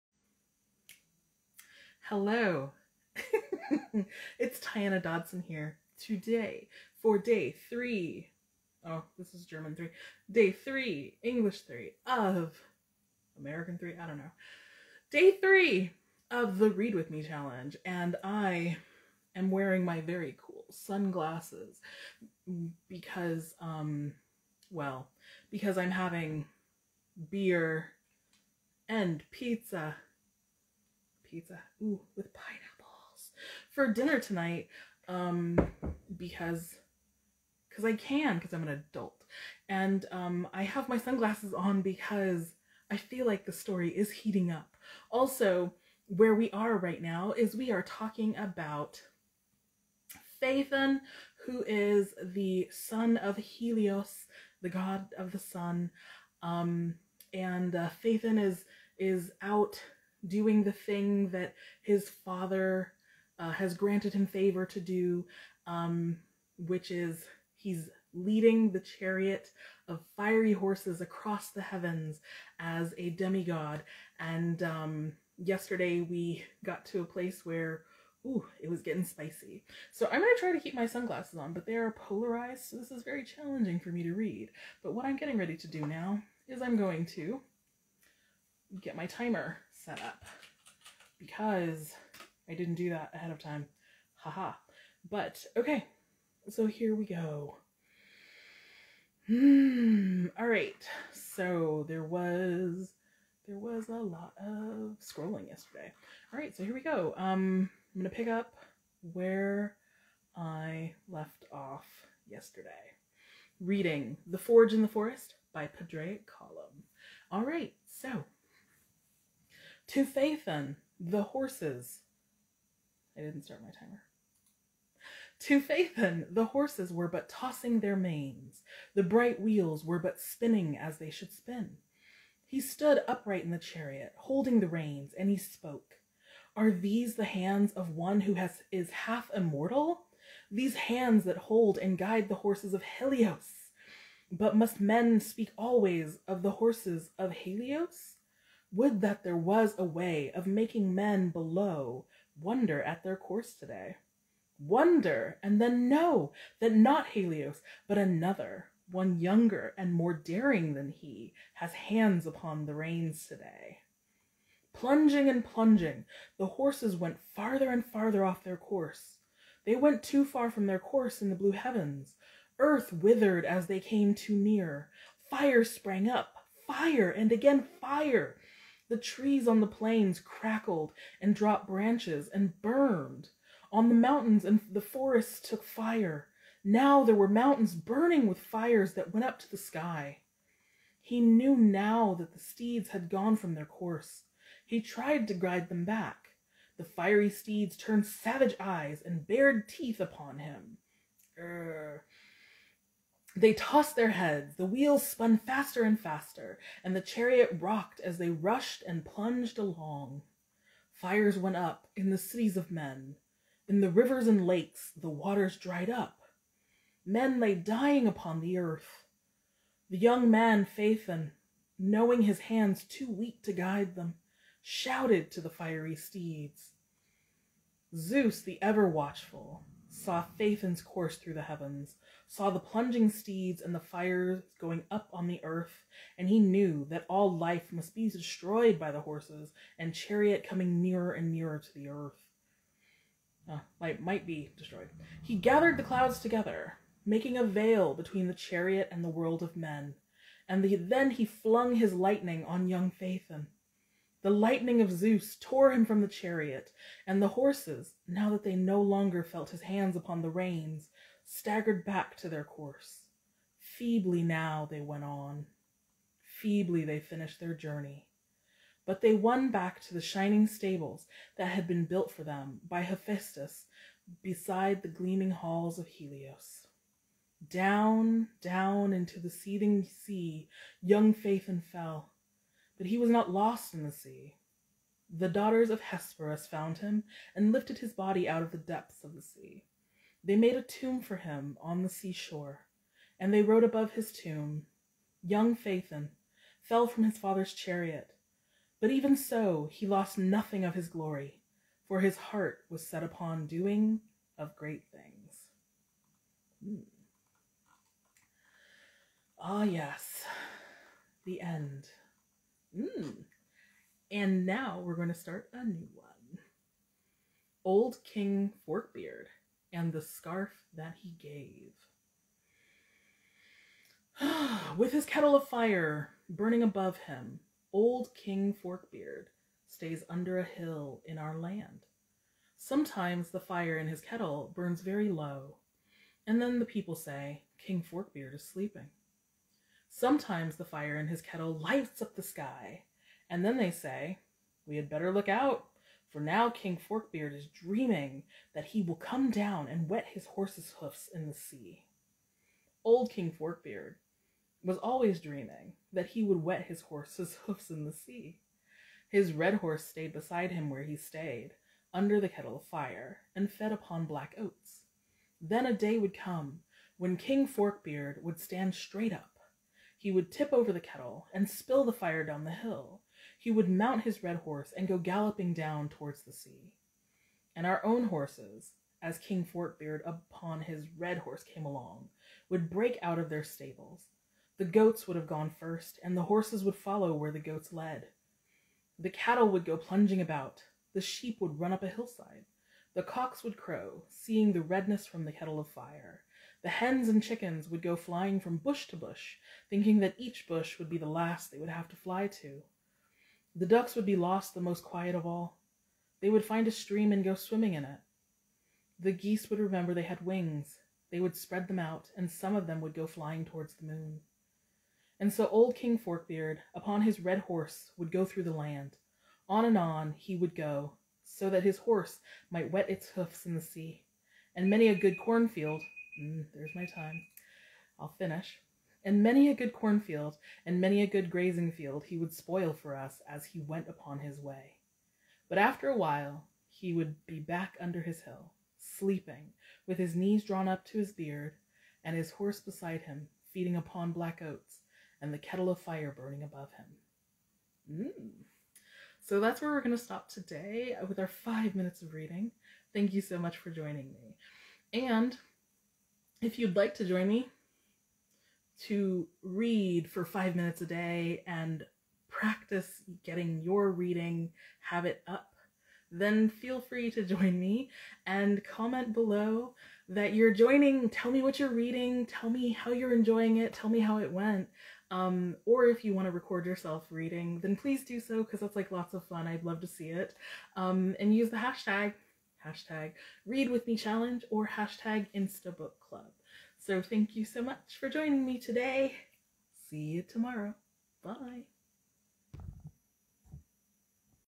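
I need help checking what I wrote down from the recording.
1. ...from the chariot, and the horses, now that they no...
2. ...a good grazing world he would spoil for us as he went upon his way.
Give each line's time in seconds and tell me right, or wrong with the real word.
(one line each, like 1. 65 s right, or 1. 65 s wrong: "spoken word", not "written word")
1. 255 s right
2. 431 s wrong: "field", not "world".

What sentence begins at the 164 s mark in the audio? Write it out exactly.
Plunging and plunging, the horses went farther and farther off their course.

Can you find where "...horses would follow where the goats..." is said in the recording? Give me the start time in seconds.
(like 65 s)
386 s.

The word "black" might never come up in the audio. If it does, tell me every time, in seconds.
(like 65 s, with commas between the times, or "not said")
364 s, 444 s.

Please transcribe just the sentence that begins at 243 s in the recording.
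Uh, ah, light might be destroyed.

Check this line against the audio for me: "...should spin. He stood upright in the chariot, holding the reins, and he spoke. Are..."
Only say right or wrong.
right.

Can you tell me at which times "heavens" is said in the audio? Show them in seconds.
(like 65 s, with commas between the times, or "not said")
71 s, 171 s, 231 s.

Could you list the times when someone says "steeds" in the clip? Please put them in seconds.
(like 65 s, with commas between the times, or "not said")
192 s, 197 s, 225 s, 233 s.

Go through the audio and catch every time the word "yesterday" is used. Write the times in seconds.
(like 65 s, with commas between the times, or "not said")
75 s, 105 s, 112 s.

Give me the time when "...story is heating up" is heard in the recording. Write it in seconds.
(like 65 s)
43 s.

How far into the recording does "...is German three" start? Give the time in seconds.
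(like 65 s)
9 s.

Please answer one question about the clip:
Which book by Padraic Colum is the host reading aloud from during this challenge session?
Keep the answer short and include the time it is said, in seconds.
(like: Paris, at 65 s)
The Forge in the Forest, at 114 s.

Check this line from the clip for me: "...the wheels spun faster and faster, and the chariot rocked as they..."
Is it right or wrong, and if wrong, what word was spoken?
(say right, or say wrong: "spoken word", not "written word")
right.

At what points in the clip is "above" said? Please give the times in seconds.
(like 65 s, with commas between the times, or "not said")
293 s, 326 s, 446 s.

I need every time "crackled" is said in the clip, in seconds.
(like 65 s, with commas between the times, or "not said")
180 s.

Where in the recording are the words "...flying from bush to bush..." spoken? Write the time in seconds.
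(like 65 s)
397 s.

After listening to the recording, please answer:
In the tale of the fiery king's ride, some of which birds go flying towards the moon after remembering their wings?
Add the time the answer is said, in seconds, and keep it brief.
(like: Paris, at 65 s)
Geese, at 409 s.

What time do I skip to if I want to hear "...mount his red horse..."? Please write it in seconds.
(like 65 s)
373 s.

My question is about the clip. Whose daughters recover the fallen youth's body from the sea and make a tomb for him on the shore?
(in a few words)
Hesperus.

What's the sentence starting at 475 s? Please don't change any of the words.
Um, or if you want to record yourself reading, then please do so because that's like lots of fun.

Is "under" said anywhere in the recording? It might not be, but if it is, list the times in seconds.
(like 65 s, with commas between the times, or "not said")
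330 s, 361 s, 437 s.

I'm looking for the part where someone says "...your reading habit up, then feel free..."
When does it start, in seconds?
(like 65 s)
463 s.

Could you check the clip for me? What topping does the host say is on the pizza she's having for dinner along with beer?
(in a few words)
Pineapples.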